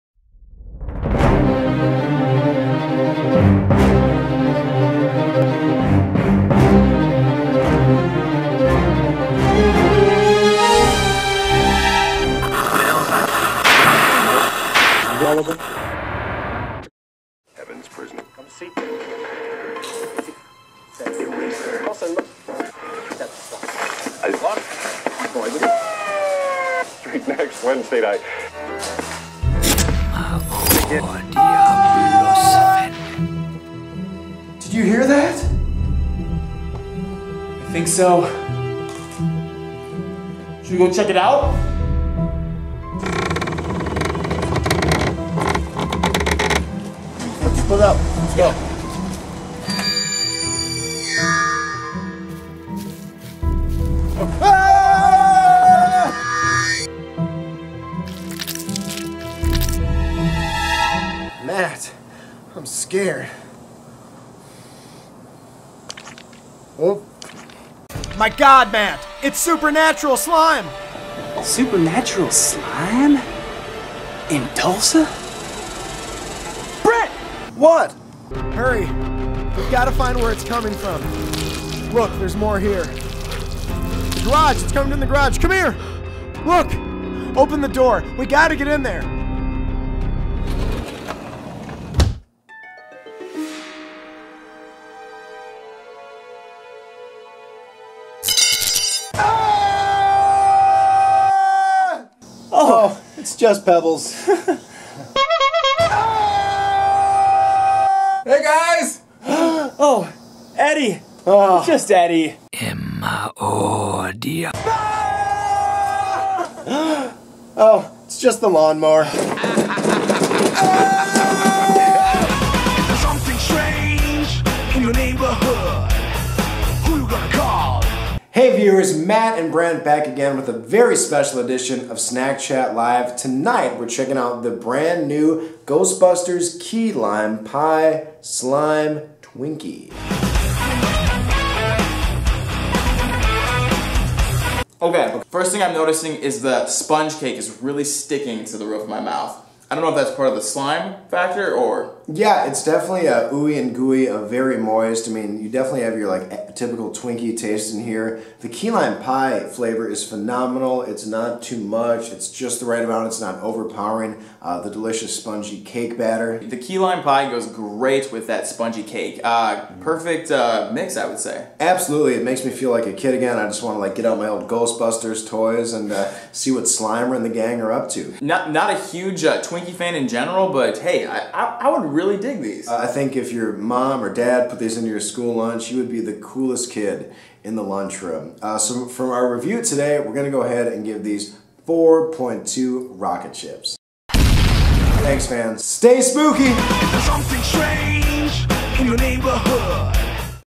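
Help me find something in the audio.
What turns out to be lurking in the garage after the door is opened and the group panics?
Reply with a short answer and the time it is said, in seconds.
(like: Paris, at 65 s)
The lawnmower, at 118 s.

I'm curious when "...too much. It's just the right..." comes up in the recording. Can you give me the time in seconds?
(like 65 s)
161 s.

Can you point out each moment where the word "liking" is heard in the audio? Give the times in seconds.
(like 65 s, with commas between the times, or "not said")
not said.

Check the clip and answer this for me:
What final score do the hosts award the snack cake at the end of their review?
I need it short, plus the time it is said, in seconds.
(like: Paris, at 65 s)
4.2 rocket ships, at 191 s.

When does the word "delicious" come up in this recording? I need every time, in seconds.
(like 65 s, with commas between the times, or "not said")
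164 s.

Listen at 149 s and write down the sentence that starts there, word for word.
I don't know if that's part of the slime factor or.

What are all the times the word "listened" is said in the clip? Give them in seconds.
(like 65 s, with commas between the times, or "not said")
not said.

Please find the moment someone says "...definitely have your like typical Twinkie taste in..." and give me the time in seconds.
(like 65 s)
155 s.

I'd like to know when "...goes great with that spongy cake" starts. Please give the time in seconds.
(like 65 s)
167 s.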